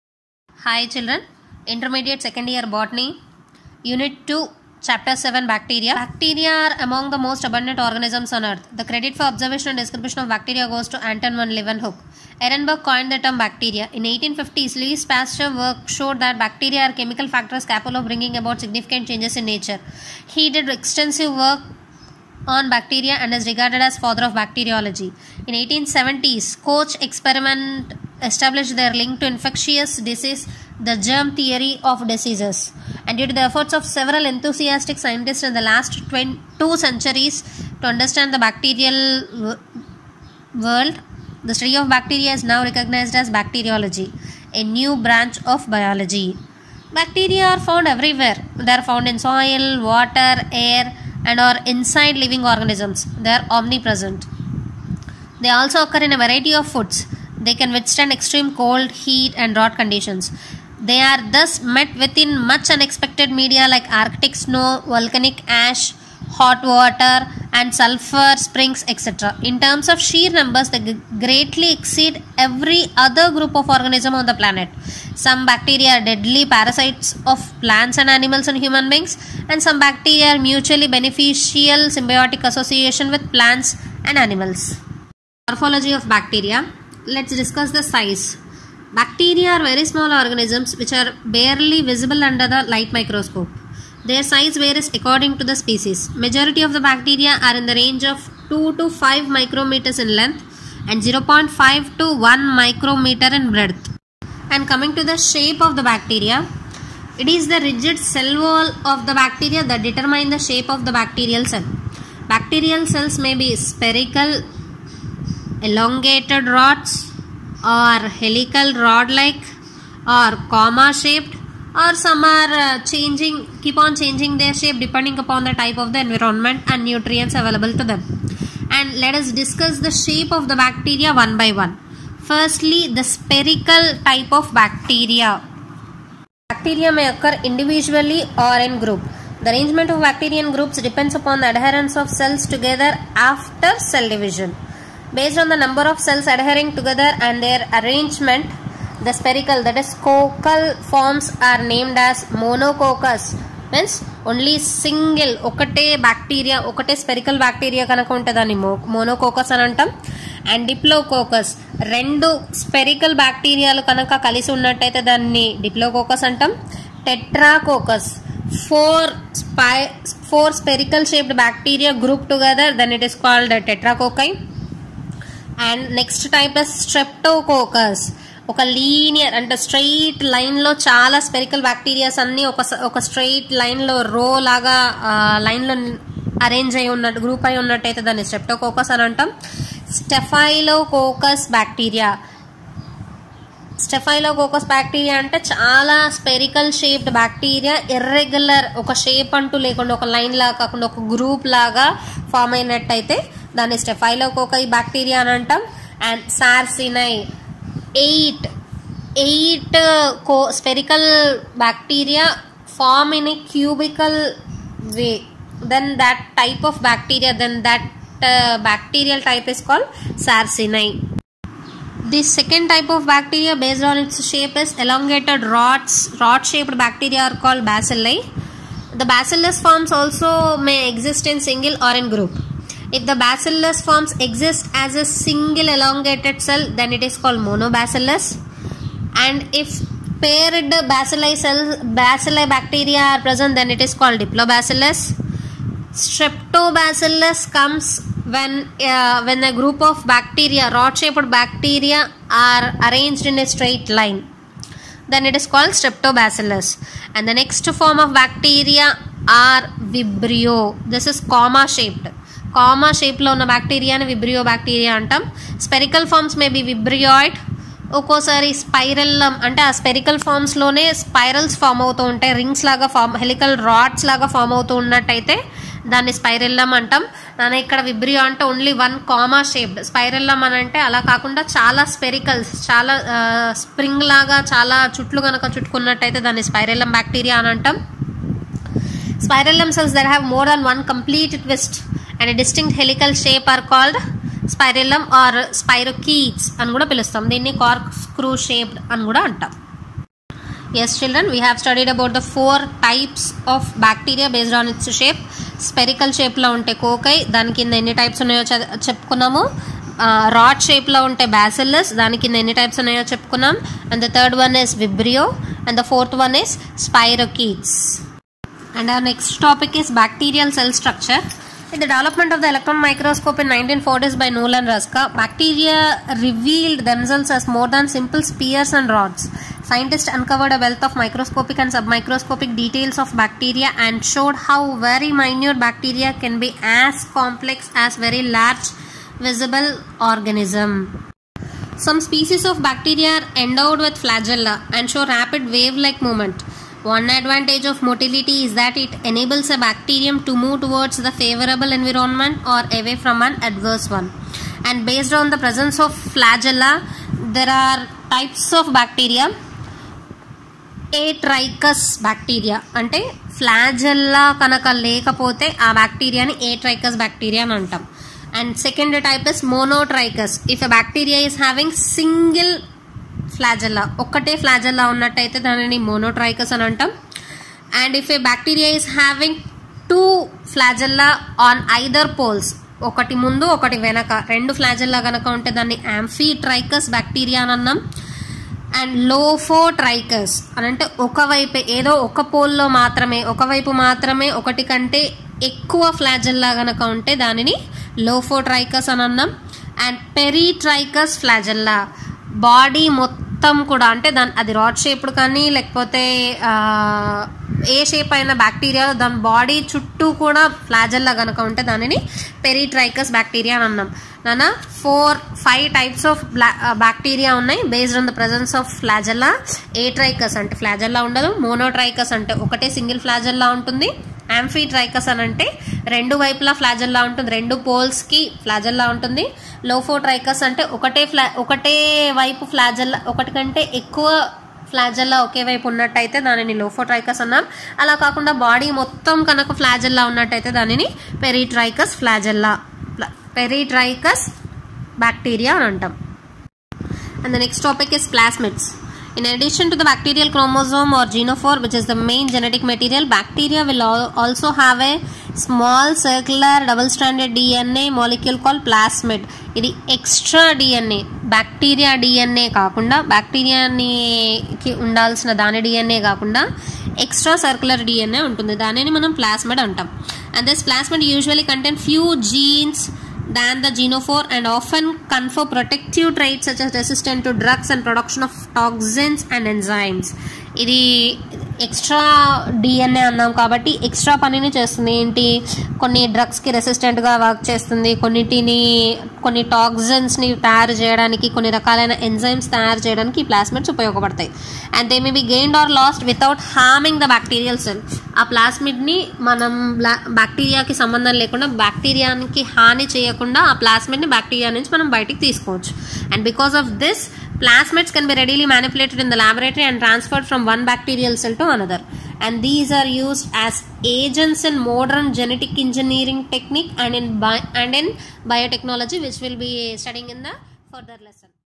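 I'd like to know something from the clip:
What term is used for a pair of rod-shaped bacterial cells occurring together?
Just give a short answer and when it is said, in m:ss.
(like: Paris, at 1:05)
Diplobacillus, at 4:03.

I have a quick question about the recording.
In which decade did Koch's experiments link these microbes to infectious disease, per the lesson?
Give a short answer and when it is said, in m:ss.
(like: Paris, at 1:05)
1870s, at 0:25.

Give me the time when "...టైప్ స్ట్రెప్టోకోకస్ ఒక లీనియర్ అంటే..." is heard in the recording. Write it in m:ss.
2:56.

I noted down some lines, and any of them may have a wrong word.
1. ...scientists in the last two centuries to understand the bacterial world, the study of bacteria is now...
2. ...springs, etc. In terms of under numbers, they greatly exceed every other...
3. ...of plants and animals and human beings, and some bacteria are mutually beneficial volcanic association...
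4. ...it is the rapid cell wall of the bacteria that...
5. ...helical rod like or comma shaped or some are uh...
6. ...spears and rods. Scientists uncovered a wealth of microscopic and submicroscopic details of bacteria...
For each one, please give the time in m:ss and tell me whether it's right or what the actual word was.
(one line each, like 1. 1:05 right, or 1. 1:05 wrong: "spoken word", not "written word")
1. 0:34 right
2. 1:08 wrong: "sheer", not "under"
3. 1:17 wrong: "symbiotic", not "volcanic"
4. 1:47 wrong: "rigid", not "rapid"
5. 1:58 right
6. 5:28 right.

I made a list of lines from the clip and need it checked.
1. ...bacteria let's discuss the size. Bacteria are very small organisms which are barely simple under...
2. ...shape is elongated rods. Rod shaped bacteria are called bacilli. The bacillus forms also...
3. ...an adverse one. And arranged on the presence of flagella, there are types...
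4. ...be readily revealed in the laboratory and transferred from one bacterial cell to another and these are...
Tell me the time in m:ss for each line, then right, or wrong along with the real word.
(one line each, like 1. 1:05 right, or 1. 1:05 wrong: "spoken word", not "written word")
1. 1:26 wrong: "visible", not "simple"
2. 3:44 right
3. 5:53 wrong: "based", not "arranged"
4. 8:28 wrong: "manipulated", not "revealed".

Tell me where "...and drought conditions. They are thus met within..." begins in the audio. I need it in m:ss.
0:59.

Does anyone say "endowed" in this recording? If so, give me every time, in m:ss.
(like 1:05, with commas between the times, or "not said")
5:43.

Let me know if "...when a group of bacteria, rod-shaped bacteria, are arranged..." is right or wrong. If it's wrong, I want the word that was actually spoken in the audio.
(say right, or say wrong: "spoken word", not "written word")
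right.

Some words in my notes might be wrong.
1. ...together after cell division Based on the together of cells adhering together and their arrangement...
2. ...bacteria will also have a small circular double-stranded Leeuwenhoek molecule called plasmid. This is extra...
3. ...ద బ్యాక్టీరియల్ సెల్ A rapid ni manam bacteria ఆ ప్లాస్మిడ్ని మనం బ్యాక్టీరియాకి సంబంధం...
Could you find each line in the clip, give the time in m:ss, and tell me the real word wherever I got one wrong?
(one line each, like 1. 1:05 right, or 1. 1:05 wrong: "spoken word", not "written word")
1. 2:22 wrong: "number", not "together"
2. 7:33 wrong: "DNA", not "Leeuwenhoek"
3. 8:17 wrong: "plasmid", not "rapid".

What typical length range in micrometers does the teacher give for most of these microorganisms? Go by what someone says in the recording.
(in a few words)
2 to 5 micrometers.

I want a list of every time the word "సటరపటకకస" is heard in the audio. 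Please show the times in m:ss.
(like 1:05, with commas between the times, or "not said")
2:56, 3:08.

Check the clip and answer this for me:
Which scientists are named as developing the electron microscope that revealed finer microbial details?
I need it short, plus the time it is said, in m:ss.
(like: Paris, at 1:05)
Knoll and Ruska, at 5:24.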